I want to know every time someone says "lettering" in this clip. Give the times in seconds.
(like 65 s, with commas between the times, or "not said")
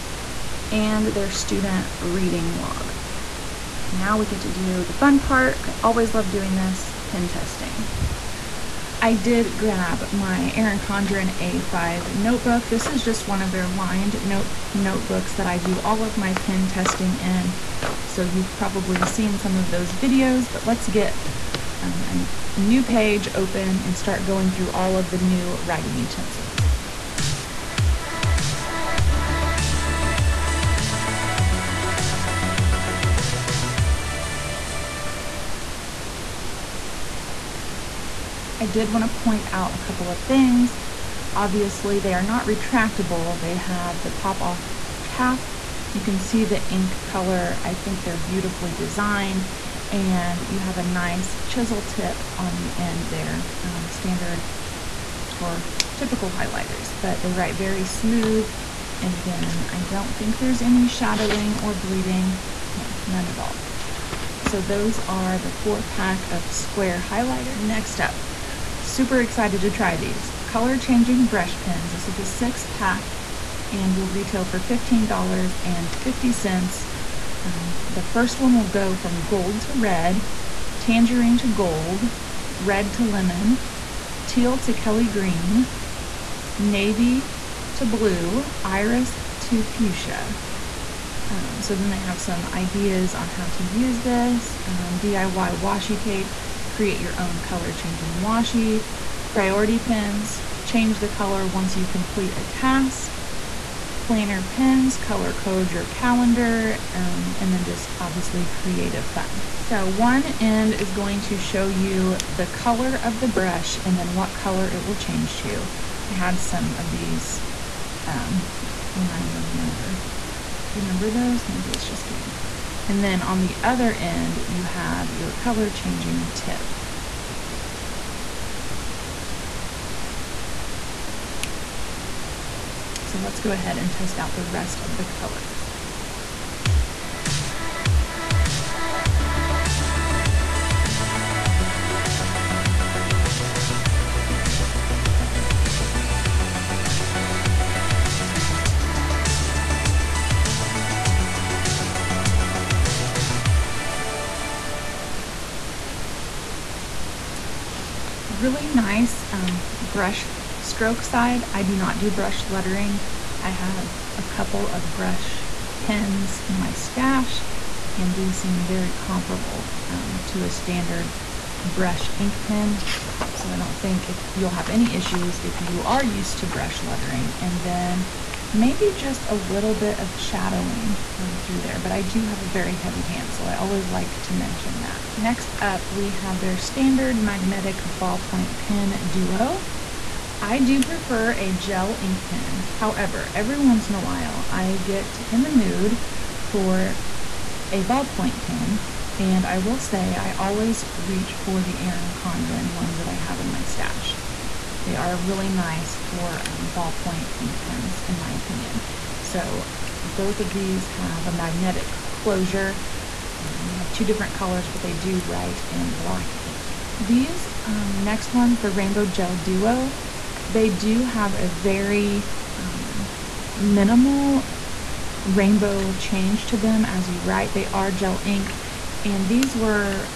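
162 s, 176 s.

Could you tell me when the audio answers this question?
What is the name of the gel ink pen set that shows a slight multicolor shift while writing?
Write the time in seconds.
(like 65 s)
218 s.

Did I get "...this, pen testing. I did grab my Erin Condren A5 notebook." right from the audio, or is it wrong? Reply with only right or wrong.
right.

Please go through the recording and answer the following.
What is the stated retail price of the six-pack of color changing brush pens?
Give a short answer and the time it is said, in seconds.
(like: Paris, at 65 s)
$15.50, at 74 s.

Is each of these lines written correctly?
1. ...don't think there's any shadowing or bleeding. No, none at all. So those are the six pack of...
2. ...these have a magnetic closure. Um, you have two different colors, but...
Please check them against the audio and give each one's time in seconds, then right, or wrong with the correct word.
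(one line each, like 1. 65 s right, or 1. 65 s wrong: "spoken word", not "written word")
1. 59 s wrong: "four", not "six"
2. 210 s right.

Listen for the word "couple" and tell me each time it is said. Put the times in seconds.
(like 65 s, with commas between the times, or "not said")
39 s, 164 s.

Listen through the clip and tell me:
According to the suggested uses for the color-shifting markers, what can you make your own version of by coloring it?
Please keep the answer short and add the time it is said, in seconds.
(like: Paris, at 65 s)
washi tape, at 95 s.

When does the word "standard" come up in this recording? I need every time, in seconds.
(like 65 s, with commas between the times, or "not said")
53 s, 170 s, 186 s.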